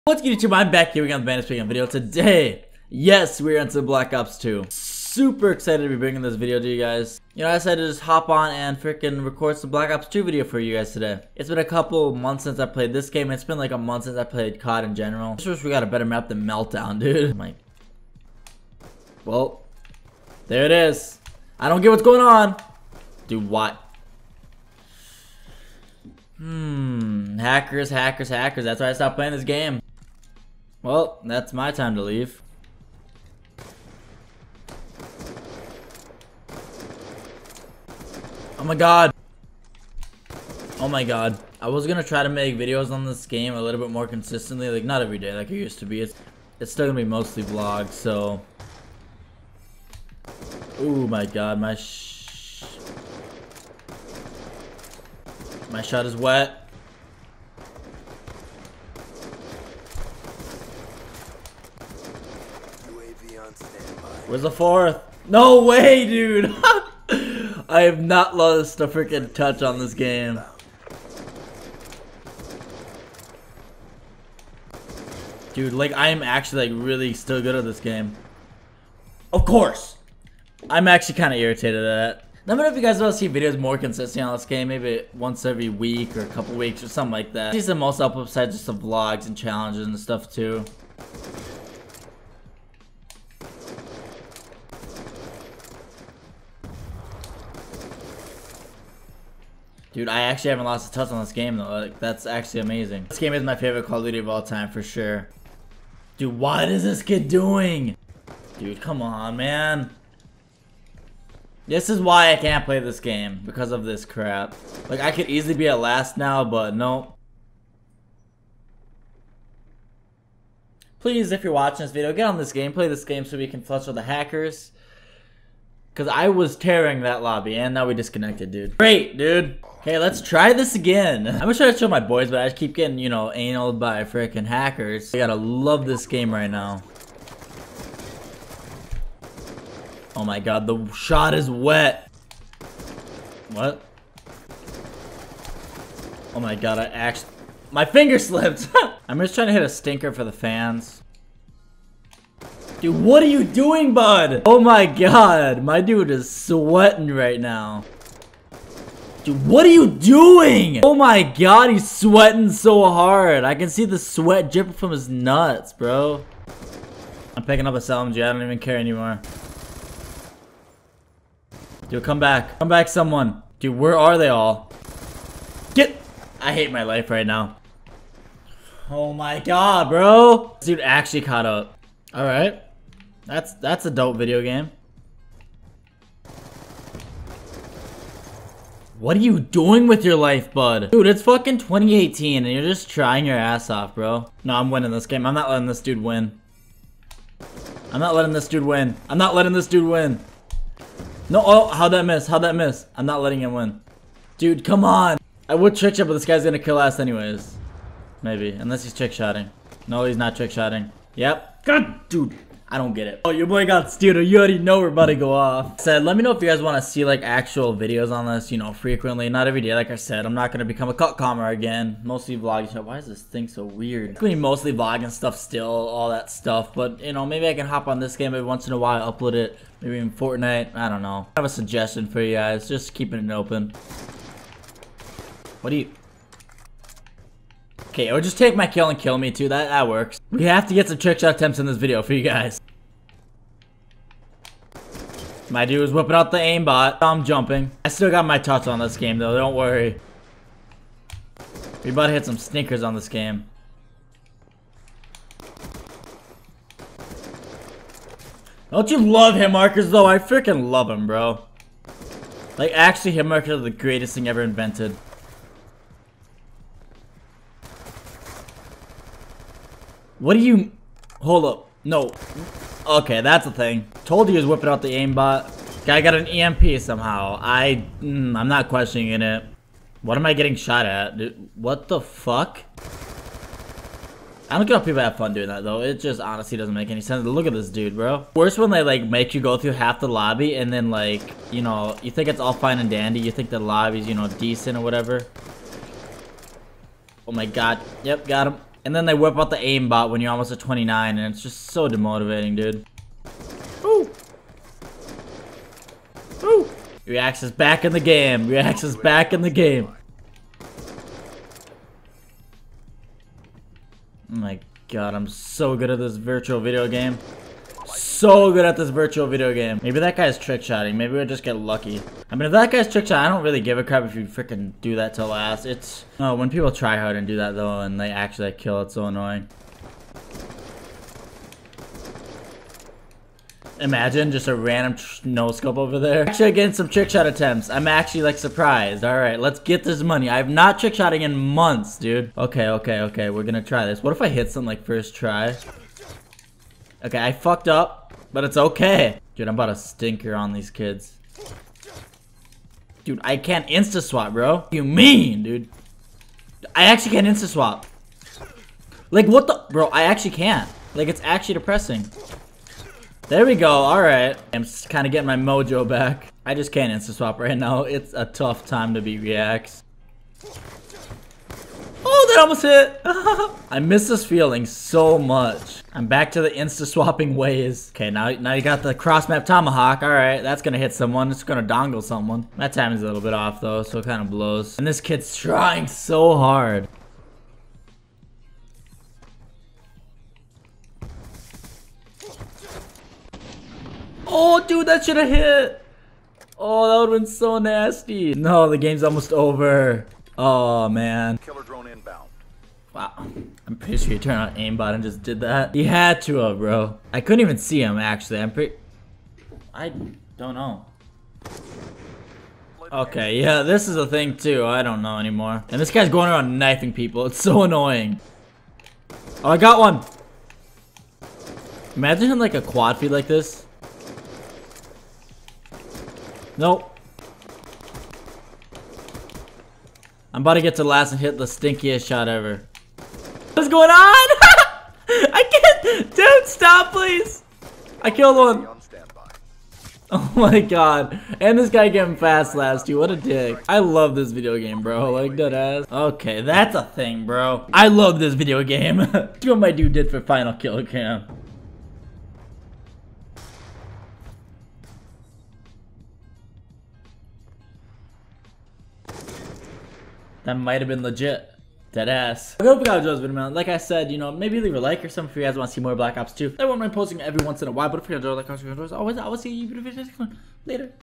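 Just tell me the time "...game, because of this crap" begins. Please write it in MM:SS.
01:52.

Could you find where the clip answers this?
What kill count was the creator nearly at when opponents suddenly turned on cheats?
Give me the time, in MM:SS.
05:00.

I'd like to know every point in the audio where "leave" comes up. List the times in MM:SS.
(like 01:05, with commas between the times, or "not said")
00:32, 07:44.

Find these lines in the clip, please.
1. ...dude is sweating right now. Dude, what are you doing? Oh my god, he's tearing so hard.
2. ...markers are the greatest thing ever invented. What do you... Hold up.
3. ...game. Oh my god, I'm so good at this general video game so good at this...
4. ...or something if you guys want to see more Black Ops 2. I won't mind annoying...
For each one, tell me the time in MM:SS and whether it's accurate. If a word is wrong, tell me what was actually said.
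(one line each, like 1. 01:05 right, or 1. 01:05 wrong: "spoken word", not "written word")
1. 02:35 wrong: "sweating", not "tearing"
2. 04:23 right
3. 05:09 wrong: "virtual", not "general"
4. 07:45 wrong: "posting", not "annoying".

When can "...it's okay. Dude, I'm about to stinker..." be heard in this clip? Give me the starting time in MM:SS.
05:48.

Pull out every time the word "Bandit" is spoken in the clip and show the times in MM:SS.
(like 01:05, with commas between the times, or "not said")
00:01.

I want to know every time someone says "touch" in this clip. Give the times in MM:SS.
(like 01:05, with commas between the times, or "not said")
01:09, 01:40, 04:08.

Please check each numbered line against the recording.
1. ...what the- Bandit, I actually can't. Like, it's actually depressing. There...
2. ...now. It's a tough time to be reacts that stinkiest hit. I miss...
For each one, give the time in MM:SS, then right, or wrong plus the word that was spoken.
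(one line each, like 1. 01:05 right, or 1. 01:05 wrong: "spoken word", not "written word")
1. 05:59 wrong: "Bro", not "Bandit"
2. 06:07 wrong: "almost", not "stinkiest".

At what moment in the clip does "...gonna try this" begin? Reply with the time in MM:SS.
05:43.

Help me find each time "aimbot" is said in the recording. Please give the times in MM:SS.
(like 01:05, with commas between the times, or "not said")
04:06, 04:34, 04:59, 06:44.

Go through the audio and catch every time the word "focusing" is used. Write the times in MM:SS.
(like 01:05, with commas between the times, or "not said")
not said.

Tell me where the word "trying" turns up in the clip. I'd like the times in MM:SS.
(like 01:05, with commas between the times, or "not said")
02:29, 03:12, 06:25.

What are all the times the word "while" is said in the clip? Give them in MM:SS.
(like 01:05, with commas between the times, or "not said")
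03:48, 07:47.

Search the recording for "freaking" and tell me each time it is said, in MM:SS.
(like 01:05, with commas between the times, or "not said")
00:08, 01:08, 02:14, 04:20, 05:24.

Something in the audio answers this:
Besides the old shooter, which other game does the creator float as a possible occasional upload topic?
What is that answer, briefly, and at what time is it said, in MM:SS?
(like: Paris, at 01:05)
Fortnite, at 03:50.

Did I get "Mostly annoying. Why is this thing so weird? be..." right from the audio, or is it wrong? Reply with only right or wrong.
wrong.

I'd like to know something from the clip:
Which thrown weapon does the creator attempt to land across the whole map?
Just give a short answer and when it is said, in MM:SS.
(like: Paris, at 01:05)
tomahawk, at 06:19.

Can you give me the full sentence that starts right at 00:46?
It's, it's still gonna be mostly vlogs, so...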